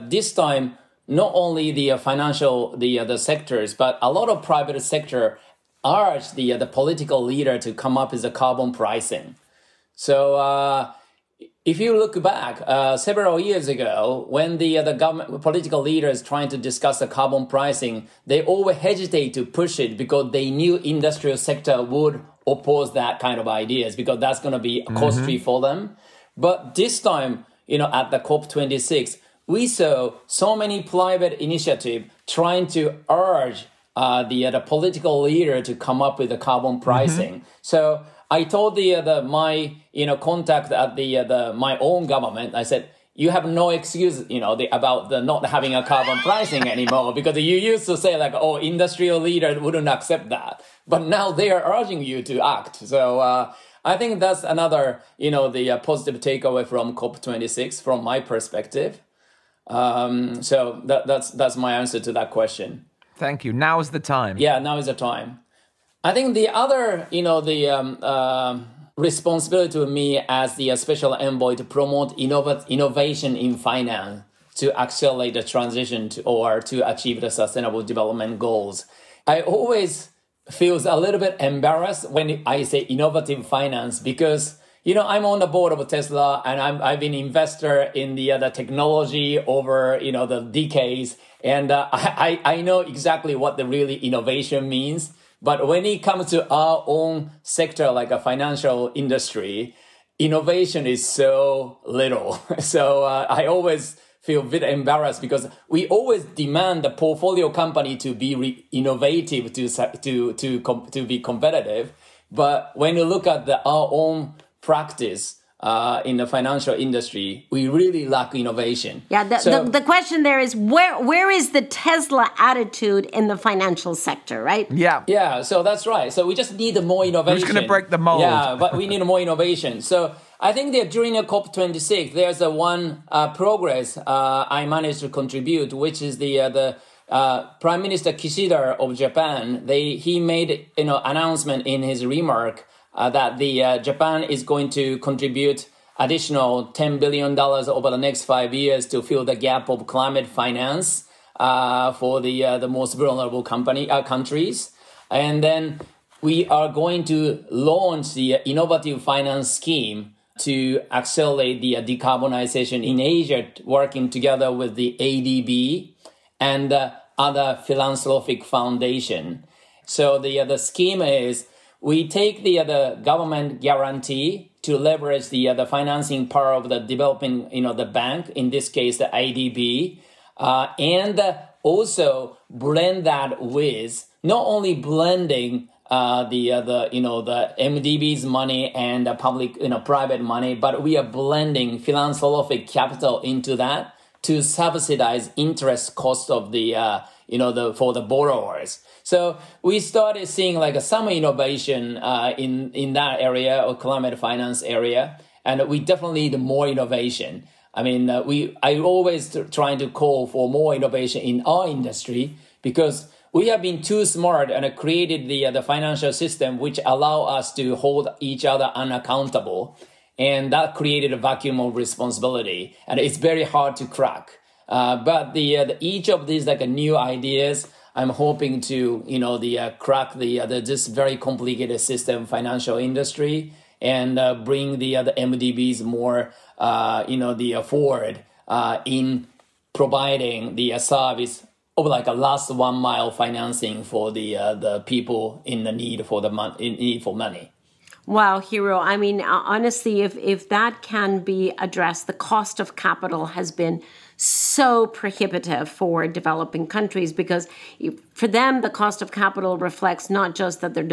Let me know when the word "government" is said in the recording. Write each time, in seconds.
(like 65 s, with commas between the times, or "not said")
15 s, 42 s, 173 s.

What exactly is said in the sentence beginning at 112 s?
But when you look at the, our own practice, uh, in the financial industry, we really lack innovation.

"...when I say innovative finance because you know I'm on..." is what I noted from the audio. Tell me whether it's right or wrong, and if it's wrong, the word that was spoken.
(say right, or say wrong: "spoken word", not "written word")
right.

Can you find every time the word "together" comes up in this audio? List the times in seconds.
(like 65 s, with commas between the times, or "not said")
164 s.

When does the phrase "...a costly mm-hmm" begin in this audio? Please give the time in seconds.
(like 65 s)
24 s.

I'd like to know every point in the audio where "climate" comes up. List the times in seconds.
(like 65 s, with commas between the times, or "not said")
149 s, 203 s.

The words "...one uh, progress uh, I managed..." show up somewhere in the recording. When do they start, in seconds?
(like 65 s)
132 s.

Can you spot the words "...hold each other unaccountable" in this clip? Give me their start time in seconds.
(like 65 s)
217 s.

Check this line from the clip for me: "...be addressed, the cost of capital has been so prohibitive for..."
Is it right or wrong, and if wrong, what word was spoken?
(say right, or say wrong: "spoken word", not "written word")
right.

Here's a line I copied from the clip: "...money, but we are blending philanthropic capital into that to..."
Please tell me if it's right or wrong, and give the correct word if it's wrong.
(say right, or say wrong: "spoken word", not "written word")
right.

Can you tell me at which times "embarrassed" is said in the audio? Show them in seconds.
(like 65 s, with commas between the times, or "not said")
81 s, 104 s.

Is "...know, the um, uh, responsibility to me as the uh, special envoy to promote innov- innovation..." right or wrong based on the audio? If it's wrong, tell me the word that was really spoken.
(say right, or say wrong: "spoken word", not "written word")
right.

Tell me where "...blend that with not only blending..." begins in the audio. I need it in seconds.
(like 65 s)
182 s.